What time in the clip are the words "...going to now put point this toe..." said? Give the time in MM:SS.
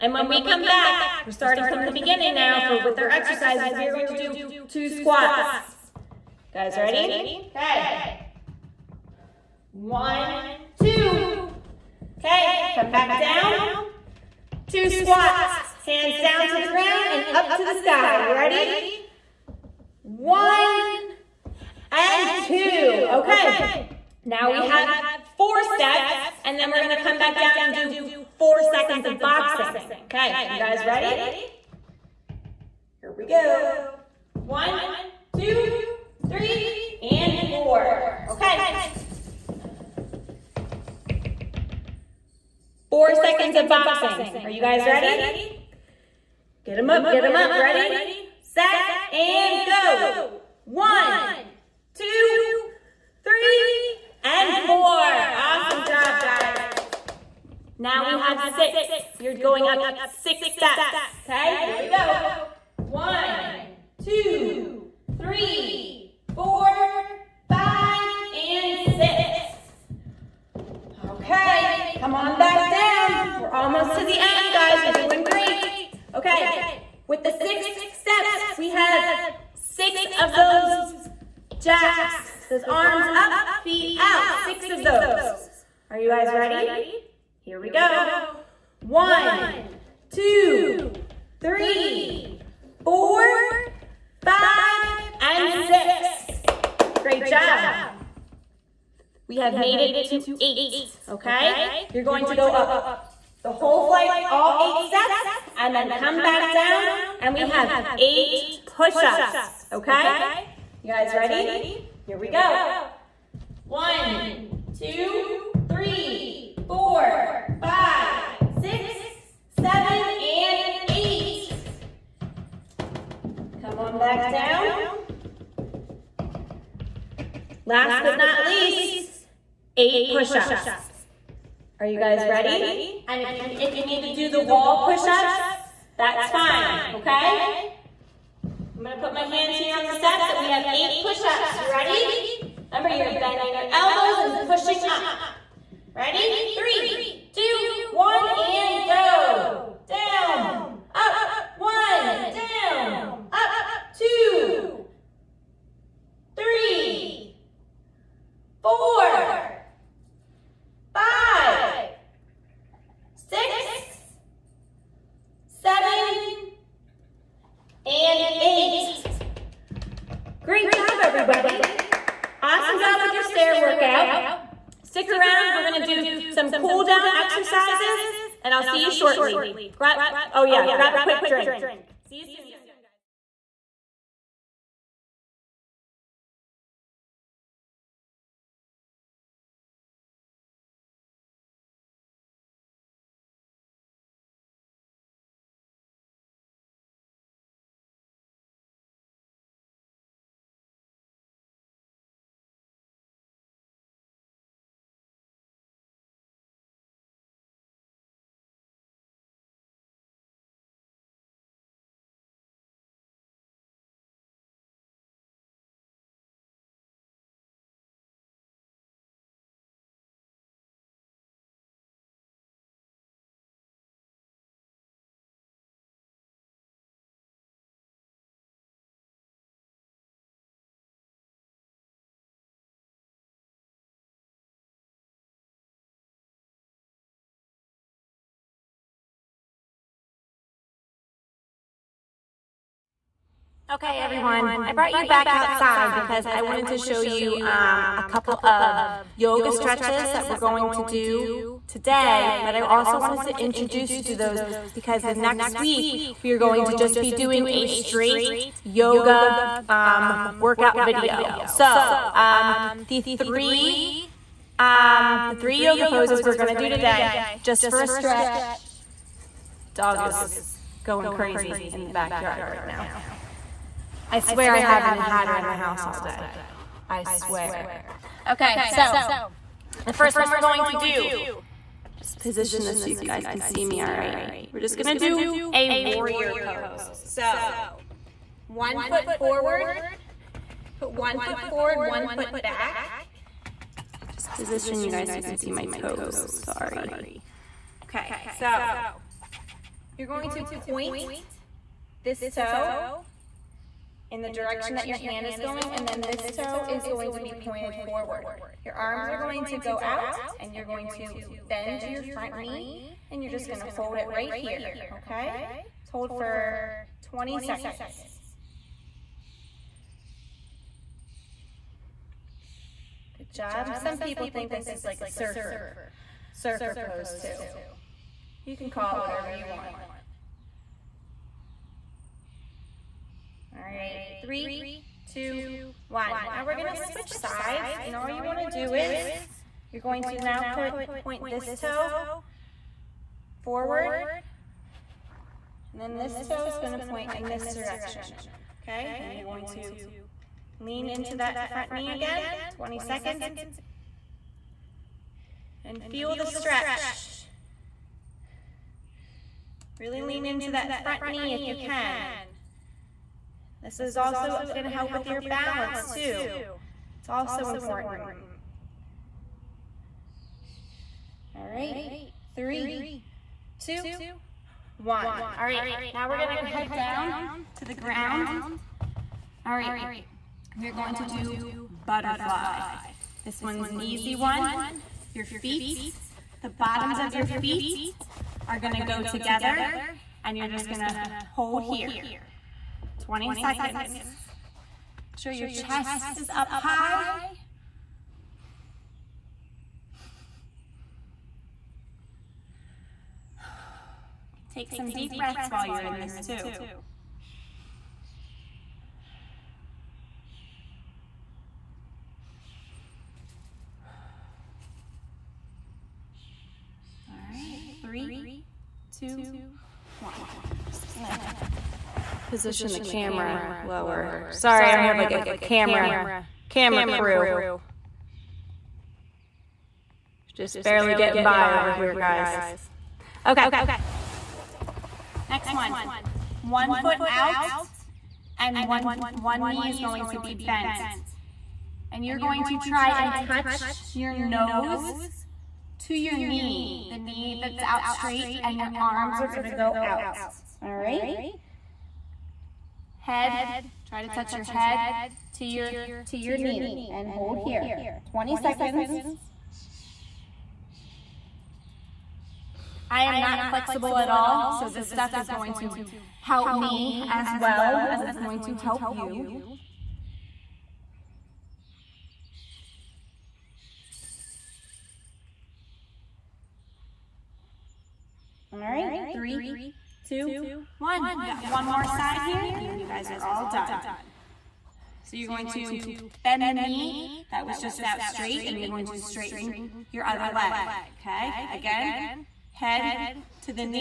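05:39.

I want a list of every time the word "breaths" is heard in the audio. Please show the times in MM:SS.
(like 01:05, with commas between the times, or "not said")
06:45.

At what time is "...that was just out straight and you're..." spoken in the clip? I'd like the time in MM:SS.
08:07.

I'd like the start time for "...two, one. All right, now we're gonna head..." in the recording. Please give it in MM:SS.
06:13.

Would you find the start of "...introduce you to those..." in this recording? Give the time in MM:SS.
04:13.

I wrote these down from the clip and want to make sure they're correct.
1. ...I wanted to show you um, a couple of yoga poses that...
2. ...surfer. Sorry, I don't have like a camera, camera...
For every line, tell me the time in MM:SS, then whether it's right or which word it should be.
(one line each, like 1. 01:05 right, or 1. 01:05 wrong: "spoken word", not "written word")
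1. 04:06 wrong: "stretches", not "poses"
2. 07:03 wrong: "lower", not "surfer".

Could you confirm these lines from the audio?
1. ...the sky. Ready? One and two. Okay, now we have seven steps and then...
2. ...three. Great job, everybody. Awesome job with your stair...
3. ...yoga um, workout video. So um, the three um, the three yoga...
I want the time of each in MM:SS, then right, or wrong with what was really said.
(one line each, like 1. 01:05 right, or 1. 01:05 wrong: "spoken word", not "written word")
1. 00:17 wrong: "four", not "seven"
2. 02:48 wrong: "eight", not "three"
3. 04:18 right.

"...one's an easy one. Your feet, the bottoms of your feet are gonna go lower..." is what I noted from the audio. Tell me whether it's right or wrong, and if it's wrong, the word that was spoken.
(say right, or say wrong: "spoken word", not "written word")
wrong: "together", not "lower".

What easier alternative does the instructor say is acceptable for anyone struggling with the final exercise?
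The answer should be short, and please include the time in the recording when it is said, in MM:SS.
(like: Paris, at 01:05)
Wall push-ups, at 02:14.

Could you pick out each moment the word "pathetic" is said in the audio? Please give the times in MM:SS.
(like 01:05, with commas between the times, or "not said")
not said.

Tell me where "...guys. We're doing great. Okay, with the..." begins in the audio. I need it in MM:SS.
01:14.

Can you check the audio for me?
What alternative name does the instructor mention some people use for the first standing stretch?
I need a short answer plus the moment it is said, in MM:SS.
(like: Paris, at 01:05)
Surfer pose, at 05:26.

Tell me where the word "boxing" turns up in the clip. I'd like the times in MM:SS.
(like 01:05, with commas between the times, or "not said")
00:29, 00:43.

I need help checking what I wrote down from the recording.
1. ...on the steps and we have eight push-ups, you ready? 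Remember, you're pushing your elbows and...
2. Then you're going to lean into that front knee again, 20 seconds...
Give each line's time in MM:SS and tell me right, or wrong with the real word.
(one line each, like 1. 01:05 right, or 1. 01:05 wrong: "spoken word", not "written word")
1. 02:19 wrong: "bending", not "pushing"
2. 05:48 right.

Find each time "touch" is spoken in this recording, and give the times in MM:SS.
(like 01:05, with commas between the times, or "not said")
07:23, 07:34.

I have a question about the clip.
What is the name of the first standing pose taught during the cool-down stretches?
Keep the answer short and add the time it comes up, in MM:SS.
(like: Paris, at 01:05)
Warrior pose, at 04:45.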